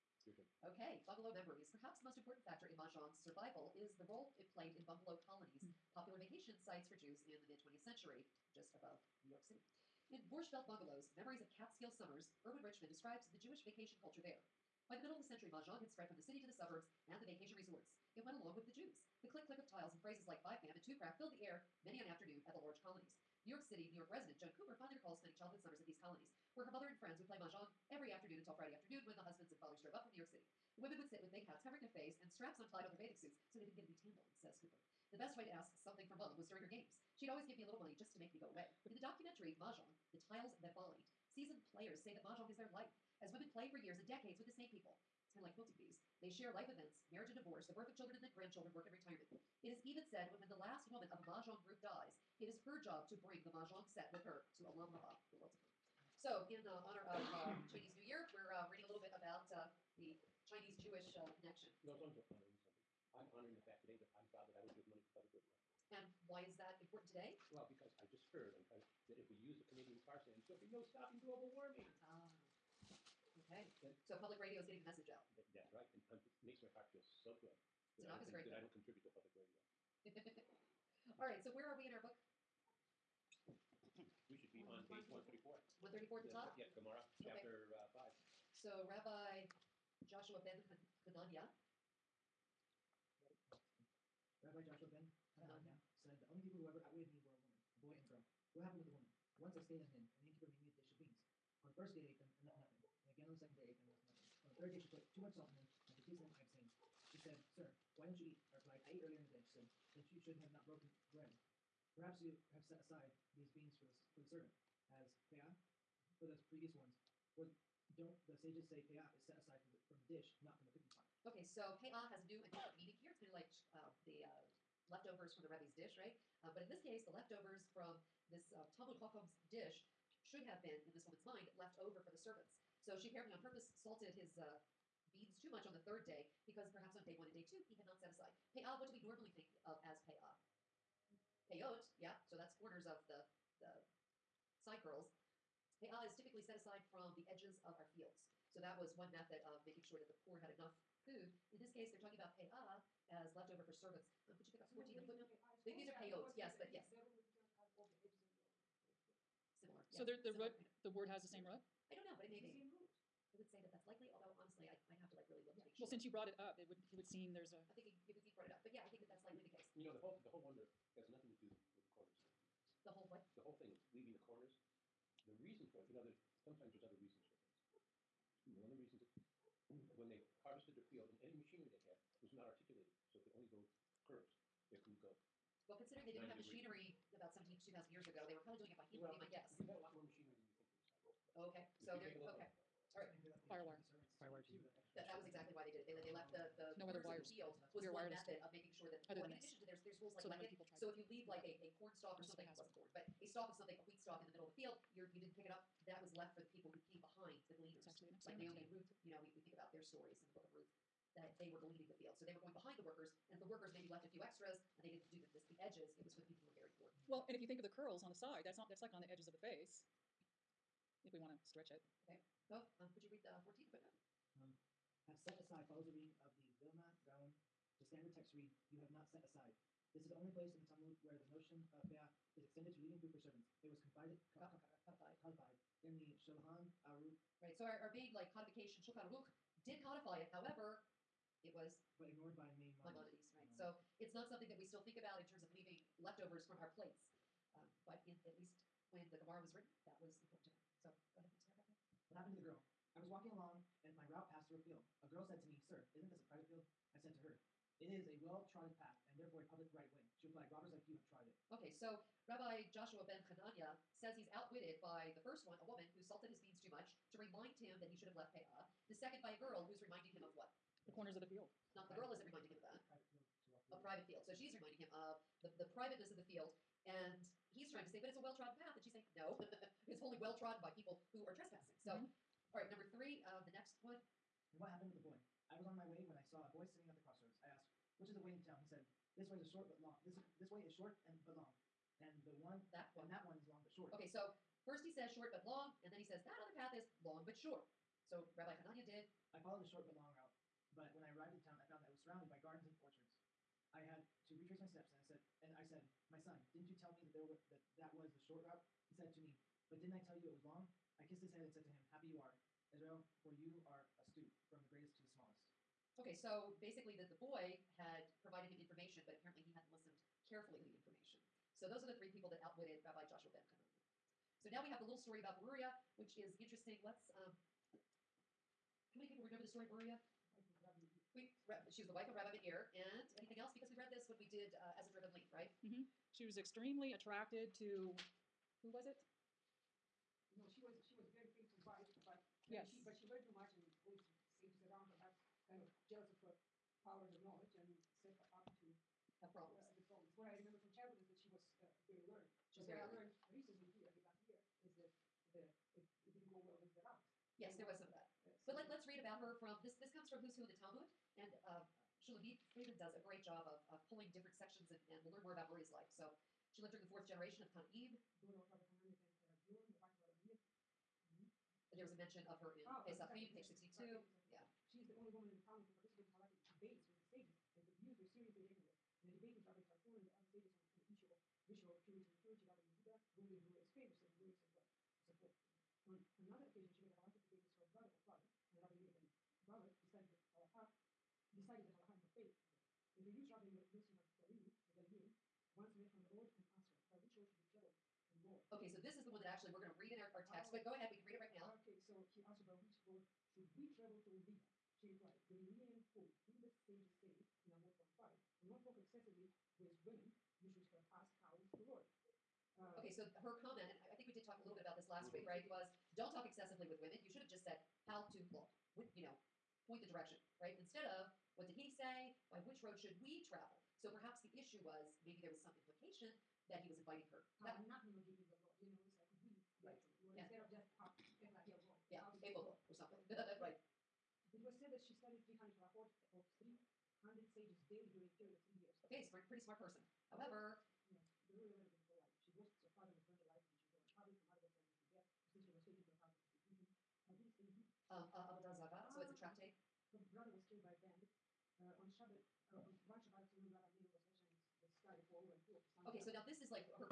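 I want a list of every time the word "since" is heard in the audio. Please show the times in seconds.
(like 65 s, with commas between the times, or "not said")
165 s.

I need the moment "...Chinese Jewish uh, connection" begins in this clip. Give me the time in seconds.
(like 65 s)
60 s.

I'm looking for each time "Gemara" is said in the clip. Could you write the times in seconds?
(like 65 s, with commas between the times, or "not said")
86 s, 249 s.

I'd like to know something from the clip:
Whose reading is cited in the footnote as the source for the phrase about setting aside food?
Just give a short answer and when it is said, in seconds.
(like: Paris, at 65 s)
Vilna Gaon, at 226 s.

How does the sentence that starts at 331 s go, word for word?
We, she was the wife of Rabbi Ben and anything else?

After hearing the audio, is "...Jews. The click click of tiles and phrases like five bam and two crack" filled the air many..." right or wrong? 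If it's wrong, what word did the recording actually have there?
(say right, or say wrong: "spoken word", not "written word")
right.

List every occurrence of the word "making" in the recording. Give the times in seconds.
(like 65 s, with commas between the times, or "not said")
149 s, 198 s.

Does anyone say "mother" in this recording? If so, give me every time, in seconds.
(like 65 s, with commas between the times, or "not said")
26 s, 444 s.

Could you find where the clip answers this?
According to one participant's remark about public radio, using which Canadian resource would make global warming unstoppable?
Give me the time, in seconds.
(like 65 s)
69 s.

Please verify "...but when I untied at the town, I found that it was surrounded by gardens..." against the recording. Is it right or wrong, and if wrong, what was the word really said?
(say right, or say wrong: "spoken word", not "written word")
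wrong: "arrived", not "untied".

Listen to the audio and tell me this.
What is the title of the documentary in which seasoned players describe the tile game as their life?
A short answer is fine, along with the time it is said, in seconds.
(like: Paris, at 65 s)
Mahjong, The Tiles That Bind, at 39 s.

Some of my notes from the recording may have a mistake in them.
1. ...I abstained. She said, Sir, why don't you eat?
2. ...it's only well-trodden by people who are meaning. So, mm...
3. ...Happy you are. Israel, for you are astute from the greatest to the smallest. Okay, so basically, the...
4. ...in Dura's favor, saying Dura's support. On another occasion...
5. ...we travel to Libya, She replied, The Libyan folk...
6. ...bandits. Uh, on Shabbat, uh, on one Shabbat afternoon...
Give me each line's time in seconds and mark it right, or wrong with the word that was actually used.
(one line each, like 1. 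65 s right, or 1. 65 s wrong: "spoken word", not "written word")
1. 106 s right
2. 279 s wrong: "trespassing", not "meaning"
3. 311 s right
4. 383 s right
5. 403 s right
6. 450 s right.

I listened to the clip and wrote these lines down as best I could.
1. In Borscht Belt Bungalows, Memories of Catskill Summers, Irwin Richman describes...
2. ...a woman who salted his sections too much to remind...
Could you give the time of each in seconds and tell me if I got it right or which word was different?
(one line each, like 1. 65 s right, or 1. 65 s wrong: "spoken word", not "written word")
1. 10 s right
2. 265 s wrong: "beans", not "sections".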